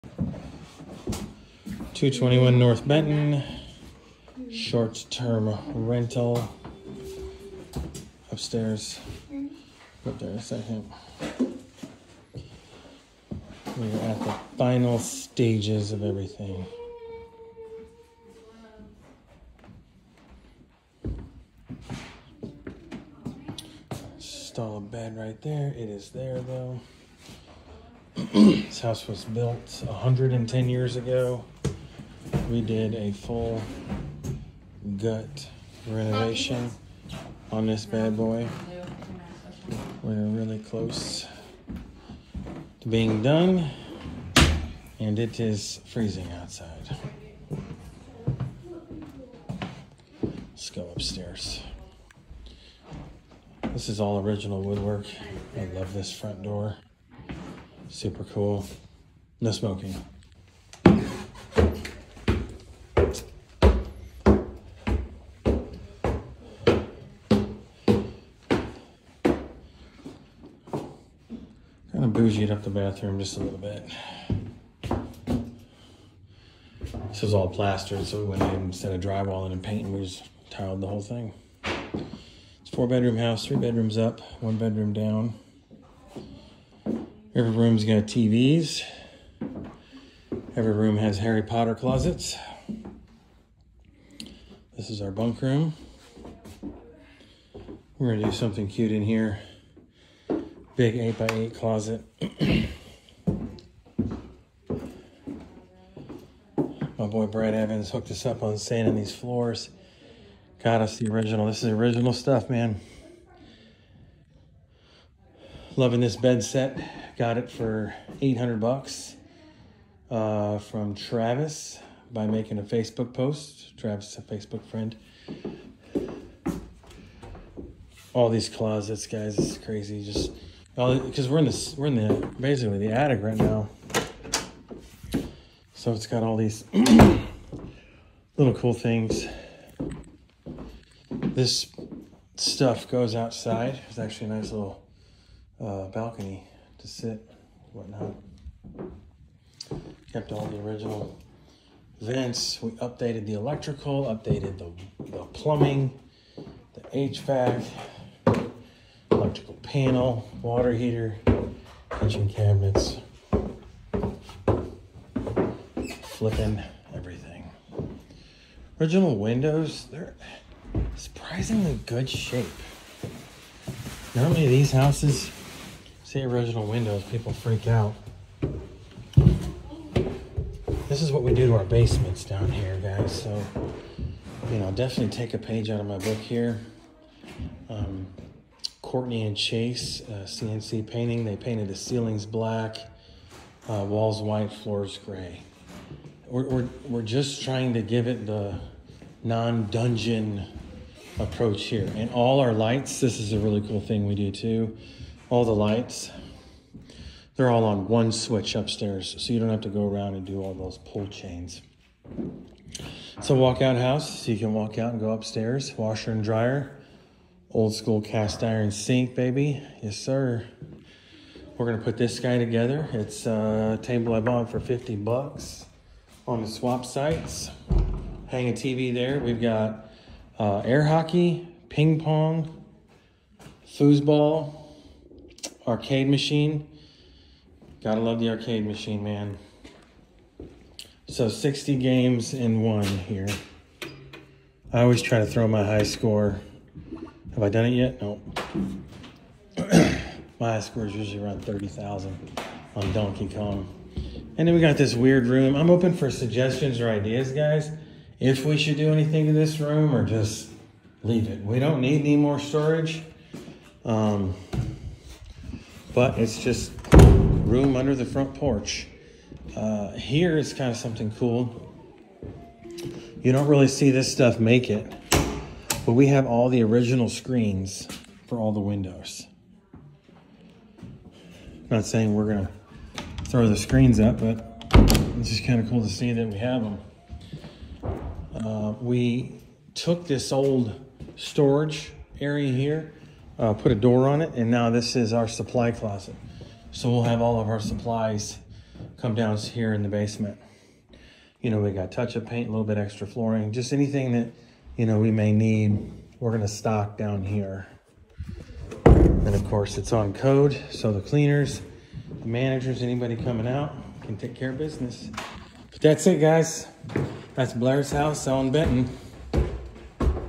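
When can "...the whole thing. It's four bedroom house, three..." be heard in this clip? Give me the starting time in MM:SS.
01:20.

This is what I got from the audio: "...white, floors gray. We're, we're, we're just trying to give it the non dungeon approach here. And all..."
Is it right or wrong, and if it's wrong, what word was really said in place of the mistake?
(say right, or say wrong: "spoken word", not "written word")
right.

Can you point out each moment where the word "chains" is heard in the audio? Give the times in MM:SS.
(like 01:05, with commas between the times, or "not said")
03:31.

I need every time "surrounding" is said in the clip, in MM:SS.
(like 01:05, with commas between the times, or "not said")
not said.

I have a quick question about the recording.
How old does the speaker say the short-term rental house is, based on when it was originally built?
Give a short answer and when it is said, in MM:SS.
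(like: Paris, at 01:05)
110 years, at 00:29.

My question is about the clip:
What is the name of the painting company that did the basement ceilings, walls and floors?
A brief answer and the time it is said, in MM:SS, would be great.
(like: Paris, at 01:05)
CNC painting, at 03:10.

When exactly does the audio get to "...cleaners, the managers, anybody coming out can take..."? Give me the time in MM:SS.
05:11.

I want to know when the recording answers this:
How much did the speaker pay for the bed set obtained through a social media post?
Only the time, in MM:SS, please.
01:58.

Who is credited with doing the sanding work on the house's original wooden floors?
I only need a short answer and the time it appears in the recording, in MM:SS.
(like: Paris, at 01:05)
Brad Evans, at 01:47.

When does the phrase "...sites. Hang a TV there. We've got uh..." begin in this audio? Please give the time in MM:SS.
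03:46.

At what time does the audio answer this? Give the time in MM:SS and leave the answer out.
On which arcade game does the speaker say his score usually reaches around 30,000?
04:12.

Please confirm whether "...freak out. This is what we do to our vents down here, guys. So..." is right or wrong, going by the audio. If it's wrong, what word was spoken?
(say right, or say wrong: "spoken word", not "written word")
wrong: "basements", not "vents".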